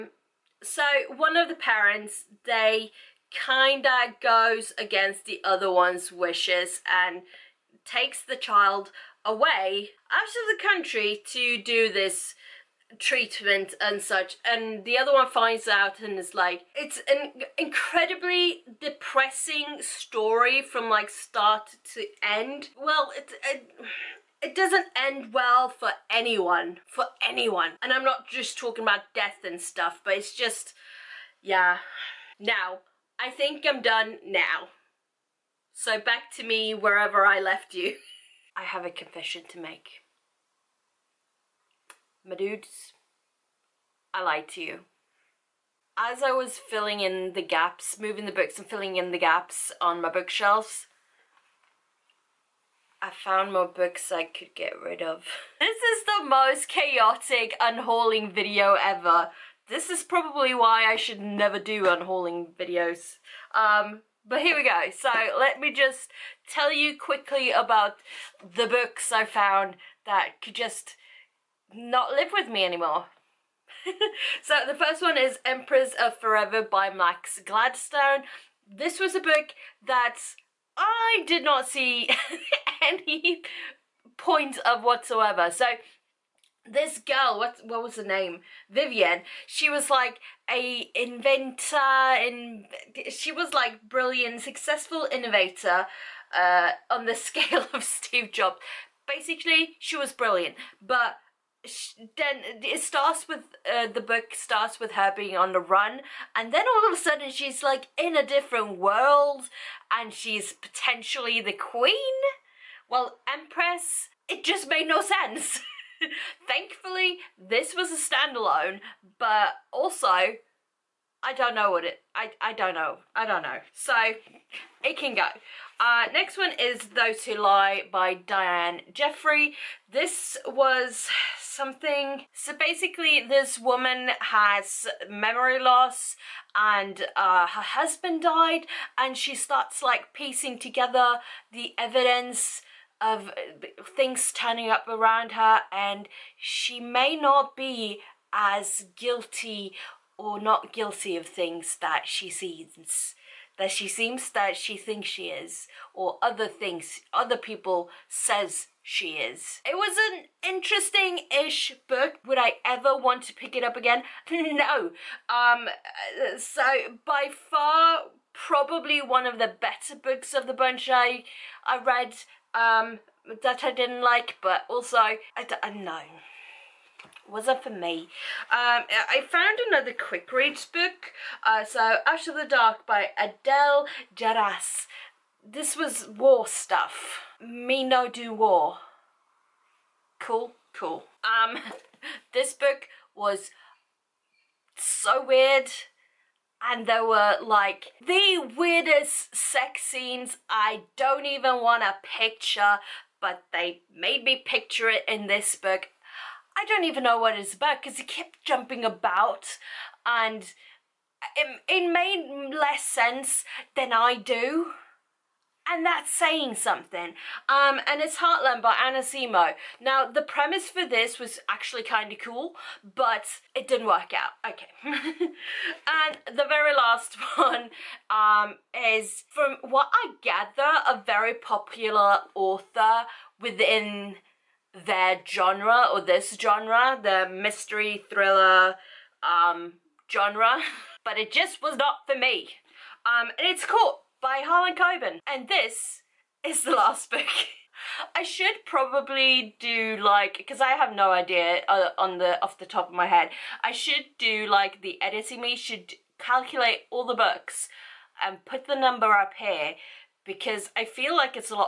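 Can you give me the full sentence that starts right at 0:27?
And I'm not just talking about death and stuff, but it's just, yeah.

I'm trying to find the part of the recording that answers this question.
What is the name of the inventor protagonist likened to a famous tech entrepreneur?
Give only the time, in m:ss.
1:28.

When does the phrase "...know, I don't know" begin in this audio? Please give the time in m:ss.
2:02.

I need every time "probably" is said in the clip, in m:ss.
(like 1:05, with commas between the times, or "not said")
1:00, 2:48, 4:08.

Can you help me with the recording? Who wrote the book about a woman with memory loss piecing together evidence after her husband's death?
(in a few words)
Diane Jeffrey.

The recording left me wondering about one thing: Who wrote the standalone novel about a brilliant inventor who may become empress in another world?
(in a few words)
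Max Gladstone.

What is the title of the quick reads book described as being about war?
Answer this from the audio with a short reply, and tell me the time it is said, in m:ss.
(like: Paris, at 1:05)
Out of the Dark, at 3:02.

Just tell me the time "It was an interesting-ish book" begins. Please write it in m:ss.
2:39.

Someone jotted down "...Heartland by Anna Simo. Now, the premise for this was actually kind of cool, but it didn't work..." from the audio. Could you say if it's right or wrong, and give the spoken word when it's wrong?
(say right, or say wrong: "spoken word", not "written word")
right.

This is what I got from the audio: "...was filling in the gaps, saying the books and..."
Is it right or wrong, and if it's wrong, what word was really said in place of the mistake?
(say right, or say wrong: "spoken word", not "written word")
wrong: "moving", not "saying".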